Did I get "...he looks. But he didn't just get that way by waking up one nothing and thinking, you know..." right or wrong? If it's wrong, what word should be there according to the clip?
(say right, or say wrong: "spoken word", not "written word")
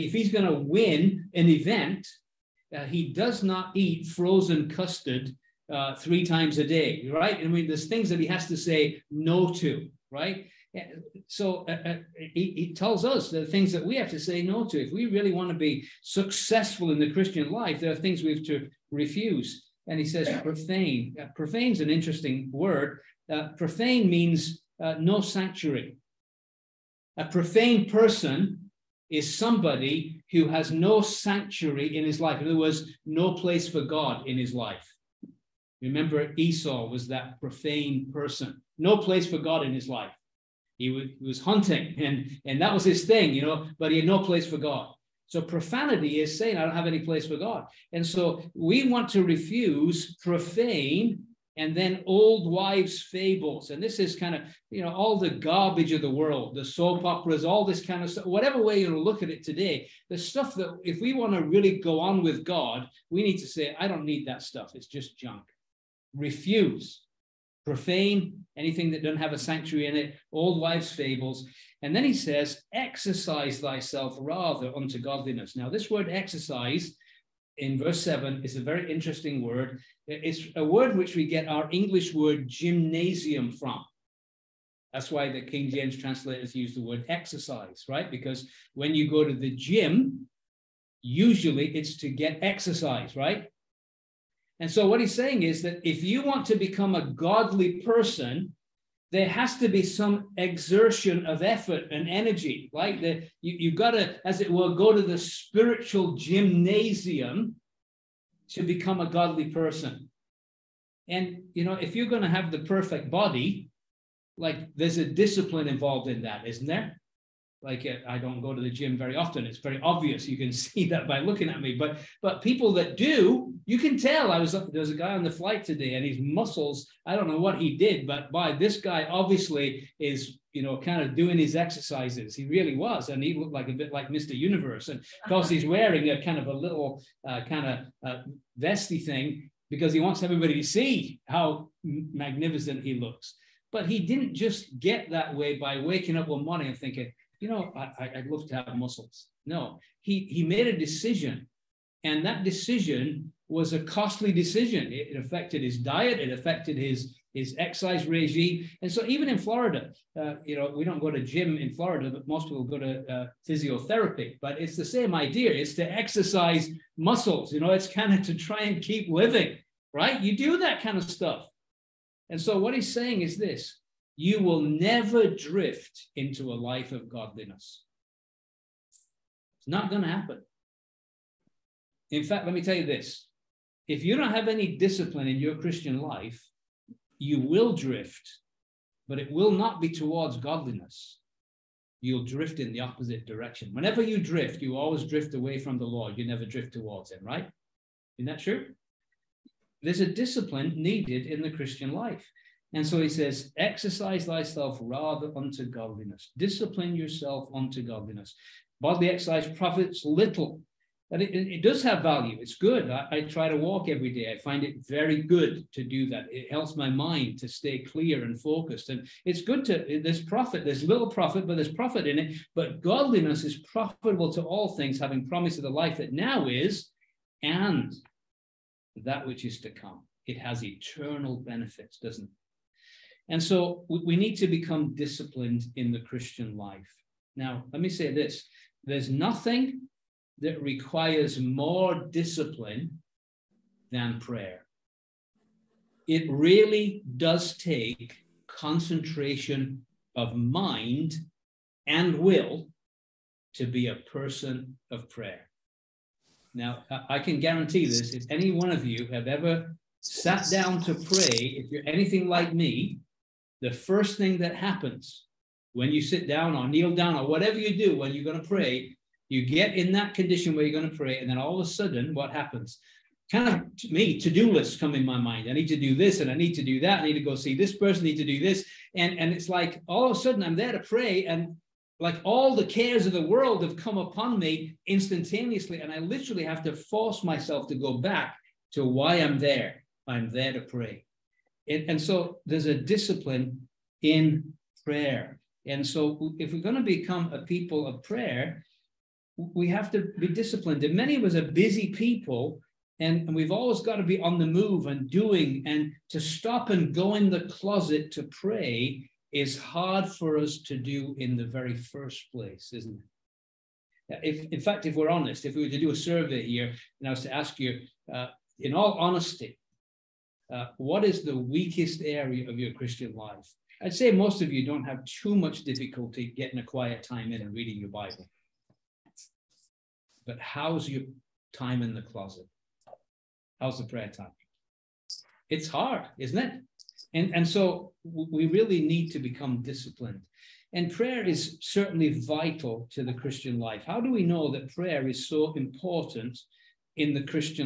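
wrong: "morning", not "nothing".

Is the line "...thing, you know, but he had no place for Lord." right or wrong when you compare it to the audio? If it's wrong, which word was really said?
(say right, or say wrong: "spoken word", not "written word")
wrong: "God", not "Lord".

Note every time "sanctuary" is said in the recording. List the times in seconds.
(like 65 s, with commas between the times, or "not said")
25 s, 31 s, 69 s.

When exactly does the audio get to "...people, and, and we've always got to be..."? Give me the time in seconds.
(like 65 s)
301 s.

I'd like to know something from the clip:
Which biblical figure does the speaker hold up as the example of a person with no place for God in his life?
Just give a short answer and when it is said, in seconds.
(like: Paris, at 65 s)
Esau, at 36 s.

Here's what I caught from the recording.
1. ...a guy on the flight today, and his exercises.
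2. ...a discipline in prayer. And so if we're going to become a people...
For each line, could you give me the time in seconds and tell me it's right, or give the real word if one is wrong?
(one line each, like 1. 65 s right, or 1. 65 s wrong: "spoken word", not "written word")
1. 124 s wrong: "muscles", not "exercises"
2. 292 s right.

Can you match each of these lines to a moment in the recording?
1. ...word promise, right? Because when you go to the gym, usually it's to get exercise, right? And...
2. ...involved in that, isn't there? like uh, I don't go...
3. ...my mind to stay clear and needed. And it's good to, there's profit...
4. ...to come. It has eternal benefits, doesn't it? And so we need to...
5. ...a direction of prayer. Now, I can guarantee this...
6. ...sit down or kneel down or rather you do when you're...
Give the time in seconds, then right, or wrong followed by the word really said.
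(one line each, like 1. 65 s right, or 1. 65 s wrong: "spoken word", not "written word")
1. 86 s wrong: "exercise", not "promise"
2. 115 s right
3. 216 s wrong: "focused", not "needed"
4. 229 s right
5. 253 s wrong: "person", not "direction"
6. 266 s wrong: "whatever", not "rather".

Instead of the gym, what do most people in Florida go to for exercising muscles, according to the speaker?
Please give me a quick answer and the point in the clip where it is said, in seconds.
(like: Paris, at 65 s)
physiotherapy, at 163 s.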